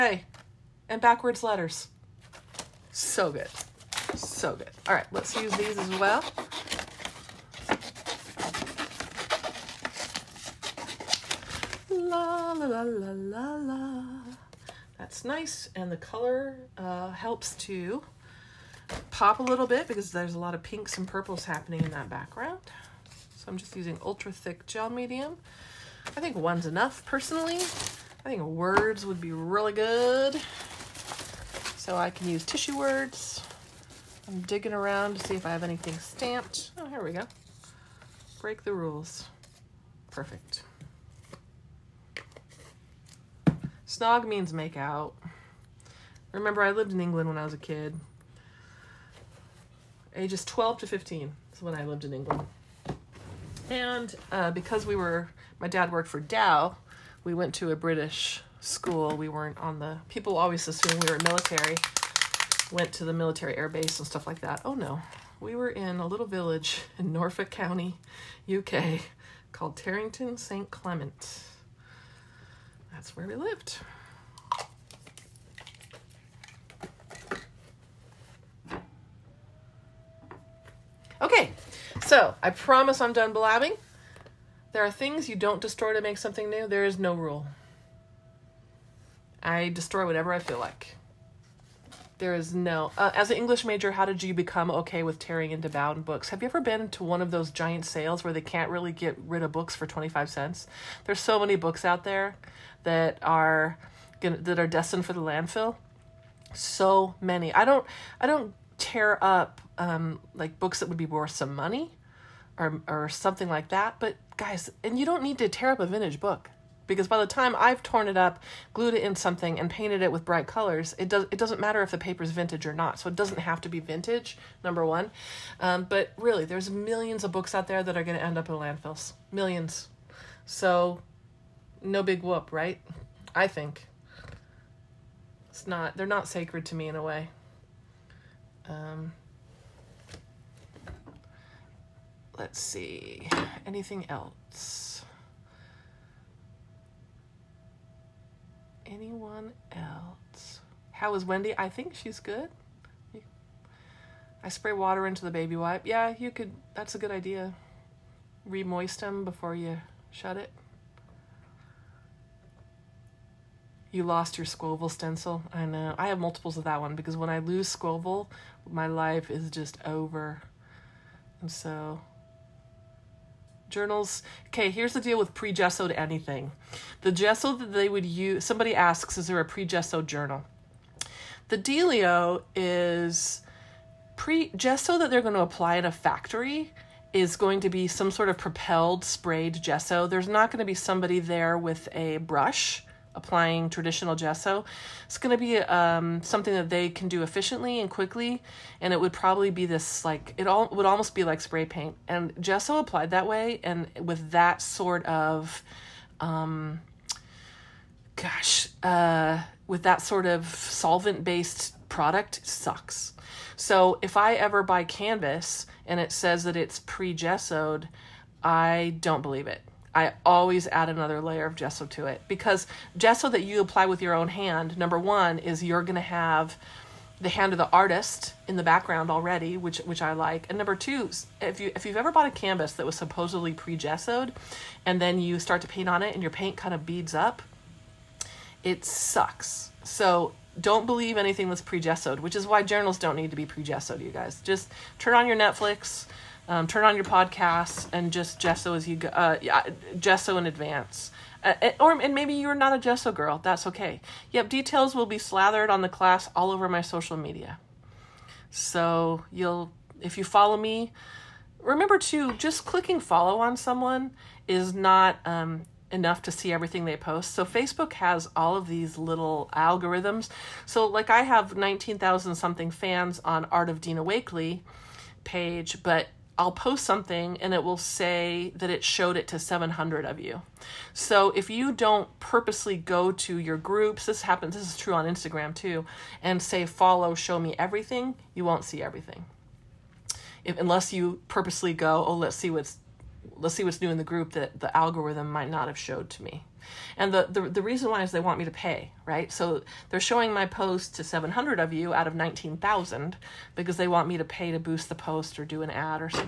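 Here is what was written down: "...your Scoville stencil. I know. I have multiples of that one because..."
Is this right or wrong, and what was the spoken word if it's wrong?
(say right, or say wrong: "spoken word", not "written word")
right.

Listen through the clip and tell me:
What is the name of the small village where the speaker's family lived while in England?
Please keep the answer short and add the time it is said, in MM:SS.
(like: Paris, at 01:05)
Terrington St. Clement, at 01:09.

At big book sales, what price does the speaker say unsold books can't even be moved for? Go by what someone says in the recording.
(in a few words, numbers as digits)
25 cents.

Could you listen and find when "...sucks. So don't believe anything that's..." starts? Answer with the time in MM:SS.
03:58.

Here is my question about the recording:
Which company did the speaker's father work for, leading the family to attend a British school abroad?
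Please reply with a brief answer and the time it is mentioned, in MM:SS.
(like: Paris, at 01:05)
Dow, at 00:56.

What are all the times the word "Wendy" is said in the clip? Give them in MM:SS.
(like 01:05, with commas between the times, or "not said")
02:31.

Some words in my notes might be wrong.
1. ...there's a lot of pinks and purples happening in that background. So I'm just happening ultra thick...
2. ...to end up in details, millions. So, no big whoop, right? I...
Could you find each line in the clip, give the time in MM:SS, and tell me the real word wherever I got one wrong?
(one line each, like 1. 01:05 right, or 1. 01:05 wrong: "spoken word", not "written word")
1. 00:20 wrong: "using", not "happening"
2. 02:08 wrong: "landfills", not "details".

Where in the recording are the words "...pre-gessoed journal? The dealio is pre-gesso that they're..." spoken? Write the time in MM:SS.
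02:59.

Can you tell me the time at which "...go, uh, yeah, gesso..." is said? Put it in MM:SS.
04:08.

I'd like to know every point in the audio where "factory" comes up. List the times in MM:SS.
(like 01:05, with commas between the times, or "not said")
03:05.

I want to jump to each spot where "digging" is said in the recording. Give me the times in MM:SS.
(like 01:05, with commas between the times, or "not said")
00:34.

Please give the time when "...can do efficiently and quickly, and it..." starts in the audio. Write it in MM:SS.
03:16.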